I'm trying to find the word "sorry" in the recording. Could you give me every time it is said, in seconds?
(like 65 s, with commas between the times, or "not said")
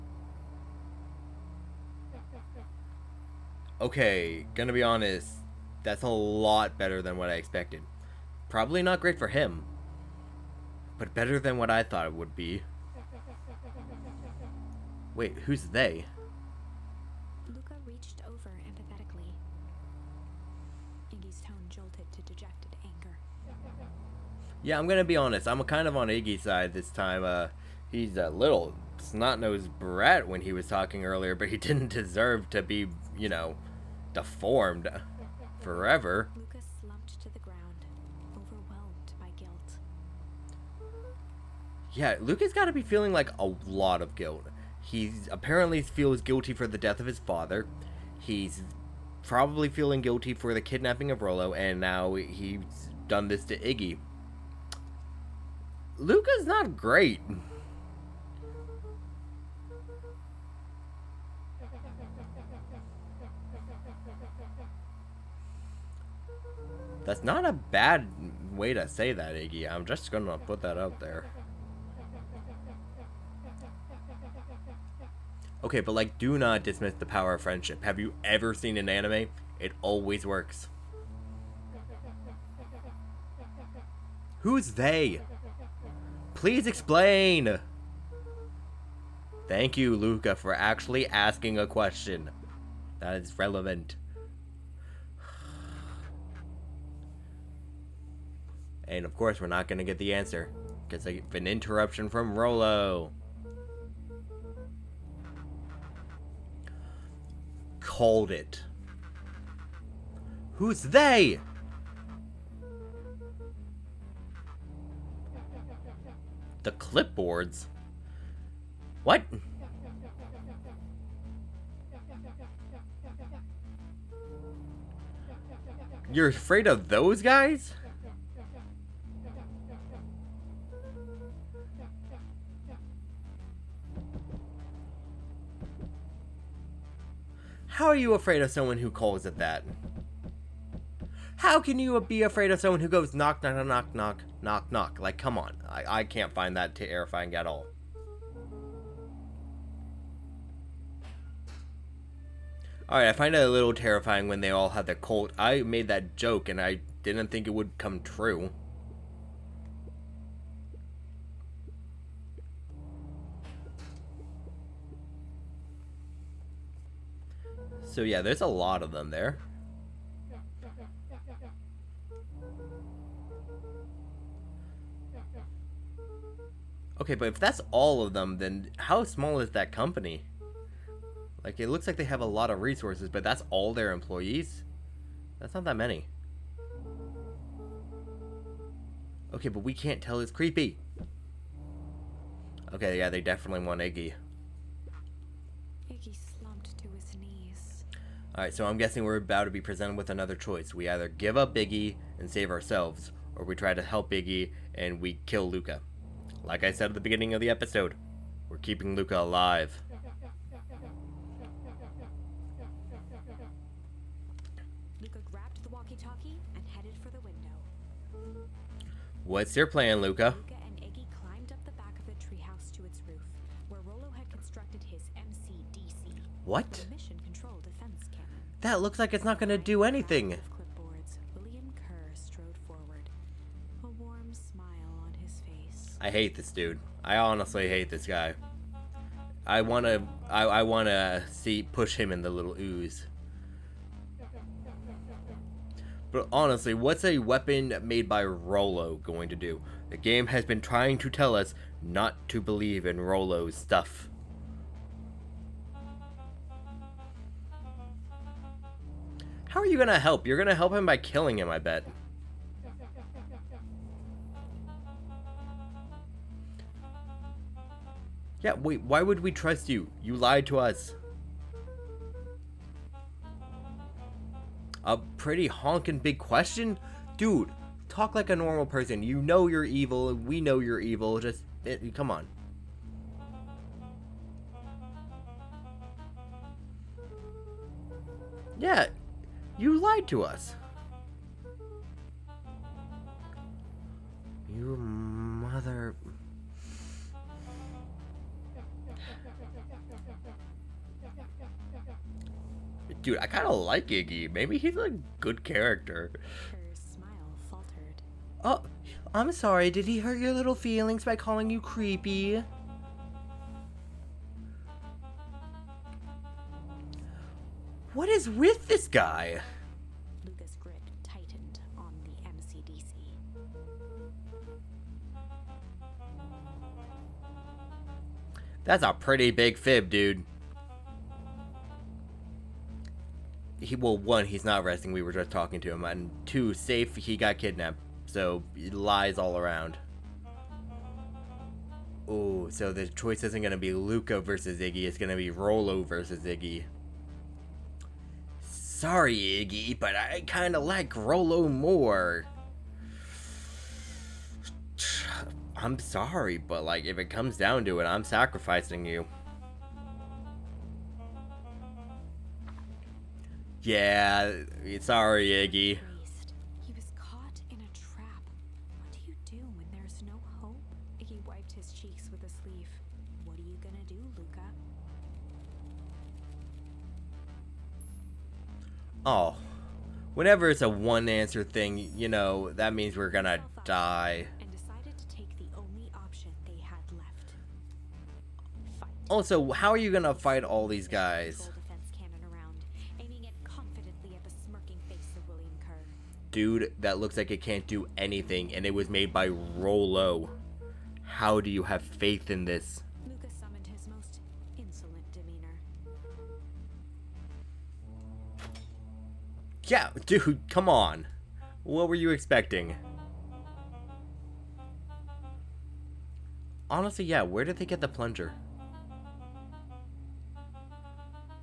309 s, 348 s, 355 s, 364 s.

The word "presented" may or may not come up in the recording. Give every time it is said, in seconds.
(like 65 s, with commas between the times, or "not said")
199 s.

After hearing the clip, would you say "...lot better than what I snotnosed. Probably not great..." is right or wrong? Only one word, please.
wrong.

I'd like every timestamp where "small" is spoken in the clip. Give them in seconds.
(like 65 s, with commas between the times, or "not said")
179 s.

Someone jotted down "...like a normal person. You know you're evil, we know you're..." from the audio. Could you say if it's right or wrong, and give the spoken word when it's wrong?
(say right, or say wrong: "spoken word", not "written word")
right.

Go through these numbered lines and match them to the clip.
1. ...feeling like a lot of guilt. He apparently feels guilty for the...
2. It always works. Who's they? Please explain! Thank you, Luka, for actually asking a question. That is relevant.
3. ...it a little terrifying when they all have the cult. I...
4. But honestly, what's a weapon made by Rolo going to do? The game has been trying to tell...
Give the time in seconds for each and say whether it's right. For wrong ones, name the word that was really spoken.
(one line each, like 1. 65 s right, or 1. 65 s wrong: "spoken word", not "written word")
1. 42 s right
2. 79 s right
3. 153 s right
4. 246 s right.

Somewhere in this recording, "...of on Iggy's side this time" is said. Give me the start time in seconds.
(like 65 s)
25 s.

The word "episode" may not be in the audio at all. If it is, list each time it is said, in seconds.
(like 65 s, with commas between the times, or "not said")
207 s.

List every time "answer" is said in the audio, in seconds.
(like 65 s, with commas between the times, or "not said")
100 s, 381 s.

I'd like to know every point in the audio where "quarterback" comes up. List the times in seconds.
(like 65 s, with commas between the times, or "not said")
not said.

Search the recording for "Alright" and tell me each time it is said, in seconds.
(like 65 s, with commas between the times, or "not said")
152 s, 198 s.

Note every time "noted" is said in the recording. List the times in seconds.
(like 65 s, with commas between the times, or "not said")
not said.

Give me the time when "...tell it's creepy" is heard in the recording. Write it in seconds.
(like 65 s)
190 s.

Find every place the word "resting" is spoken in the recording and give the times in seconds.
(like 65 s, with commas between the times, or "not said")
334 s.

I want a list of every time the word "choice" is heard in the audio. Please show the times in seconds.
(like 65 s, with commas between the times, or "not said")
200 s, 342 s.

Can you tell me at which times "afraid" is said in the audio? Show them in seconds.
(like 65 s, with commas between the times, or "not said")
126 s, 138 s, 142 s.